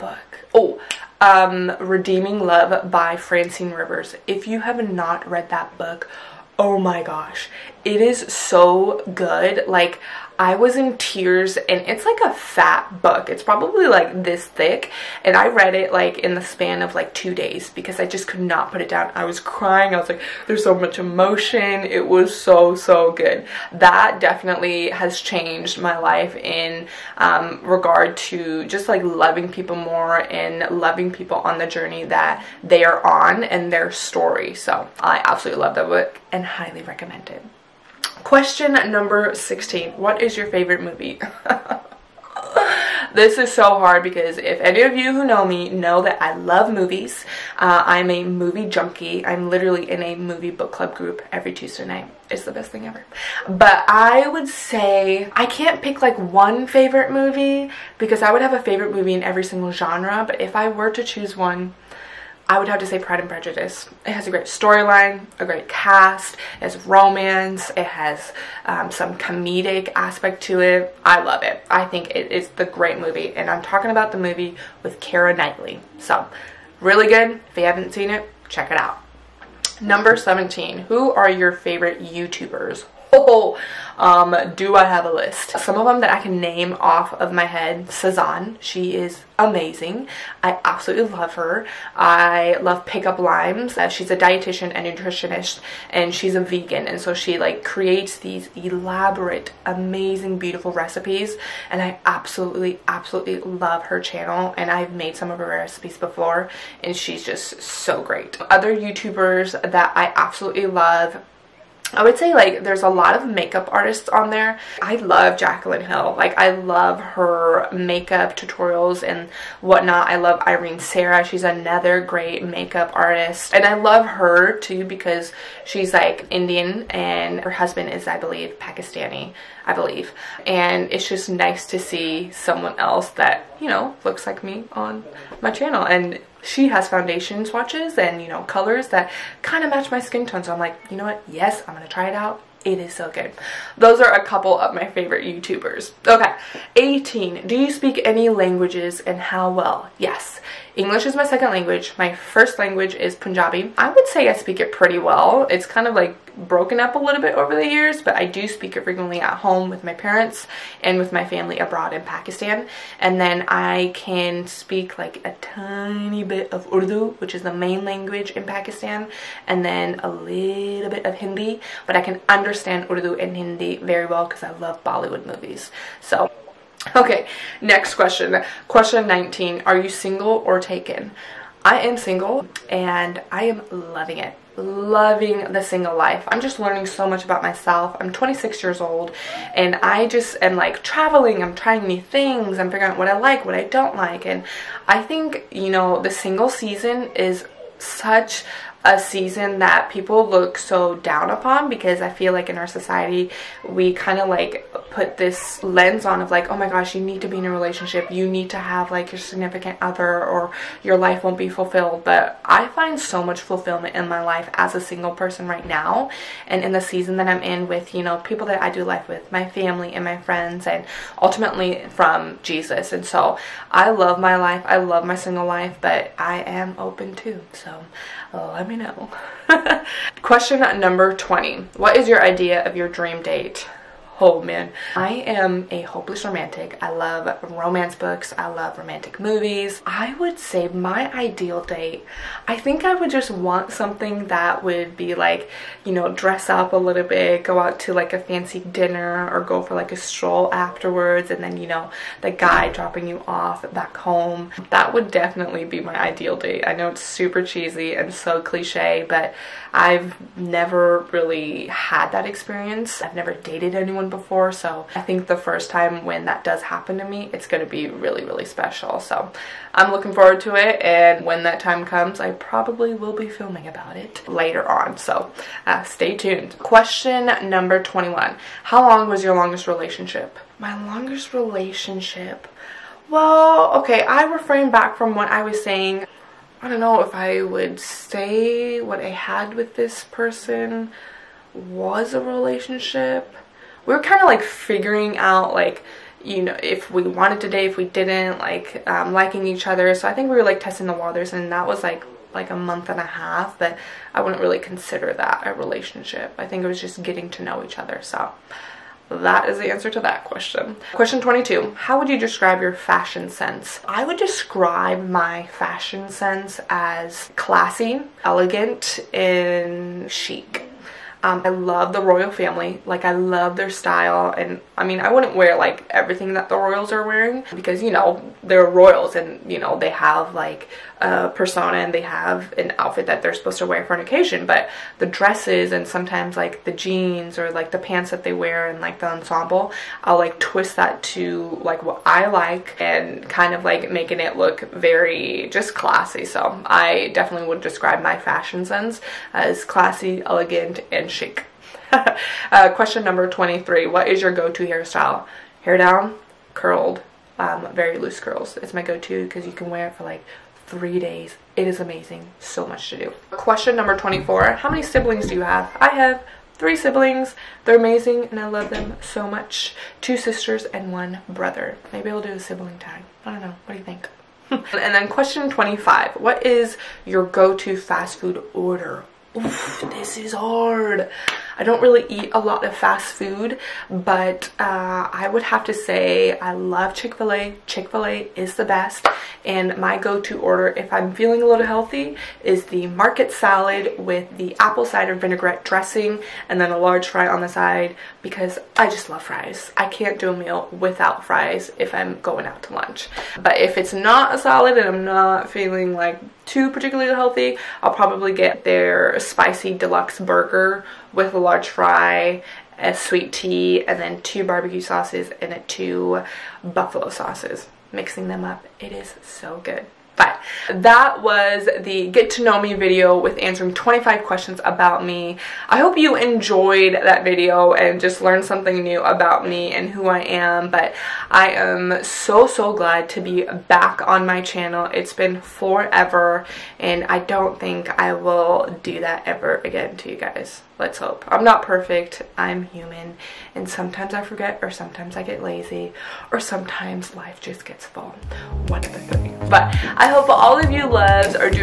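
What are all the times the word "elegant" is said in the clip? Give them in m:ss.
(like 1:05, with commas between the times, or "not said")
5:18, 5:50.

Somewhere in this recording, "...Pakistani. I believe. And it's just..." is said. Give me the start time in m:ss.
2:08.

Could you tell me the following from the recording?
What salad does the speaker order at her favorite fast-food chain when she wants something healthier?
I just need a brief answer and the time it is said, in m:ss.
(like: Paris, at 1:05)
market salad, at 6:32.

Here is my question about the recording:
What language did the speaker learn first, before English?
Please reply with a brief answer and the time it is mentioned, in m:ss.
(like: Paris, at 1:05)
Punjabi, at 2:33.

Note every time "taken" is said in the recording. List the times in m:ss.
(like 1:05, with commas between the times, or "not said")
3:00.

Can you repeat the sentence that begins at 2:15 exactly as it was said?
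And she has foundation swatches and, you know, colors that kind of match my skin tone.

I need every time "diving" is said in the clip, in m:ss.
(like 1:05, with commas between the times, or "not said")
not said.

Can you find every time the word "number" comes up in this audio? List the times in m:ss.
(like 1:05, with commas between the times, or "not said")
0:38, 1:19, 3:50, 4:37, 5:53, 6:03.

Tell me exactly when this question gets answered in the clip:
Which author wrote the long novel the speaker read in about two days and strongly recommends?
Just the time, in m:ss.
0:03.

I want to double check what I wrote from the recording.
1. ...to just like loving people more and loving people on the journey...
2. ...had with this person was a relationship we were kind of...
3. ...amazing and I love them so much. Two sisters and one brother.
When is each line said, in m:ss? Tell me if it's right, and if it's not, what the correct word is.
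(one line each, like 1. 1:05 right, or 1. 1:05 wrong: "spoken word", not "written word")
1. 0:28 right
2. 4:49 right
3. 6:07 right.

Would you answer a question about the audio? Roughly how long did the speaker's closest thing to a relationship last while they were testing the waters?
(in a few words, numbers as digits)
a month and a half.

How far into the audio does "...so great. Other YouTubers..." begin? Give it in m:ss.
1:47.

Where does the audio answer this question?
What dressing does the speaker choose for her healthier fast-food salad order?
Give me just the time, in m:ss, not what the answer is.
6:34.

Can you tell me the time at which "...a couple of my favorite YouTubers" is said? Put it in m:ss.
2:24.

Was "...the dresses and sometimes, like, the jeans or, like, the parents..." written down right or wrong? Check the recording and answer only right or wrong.
wrong.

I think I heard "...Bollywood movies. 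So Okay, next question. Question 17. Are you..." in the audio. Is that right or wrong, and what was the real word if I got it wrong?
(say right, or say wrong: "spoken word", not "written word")
wrong: "19", not "17".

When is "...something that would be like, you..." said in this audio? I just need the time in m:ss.
4:03.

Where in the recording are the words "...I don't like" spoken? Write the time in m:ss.
3:13.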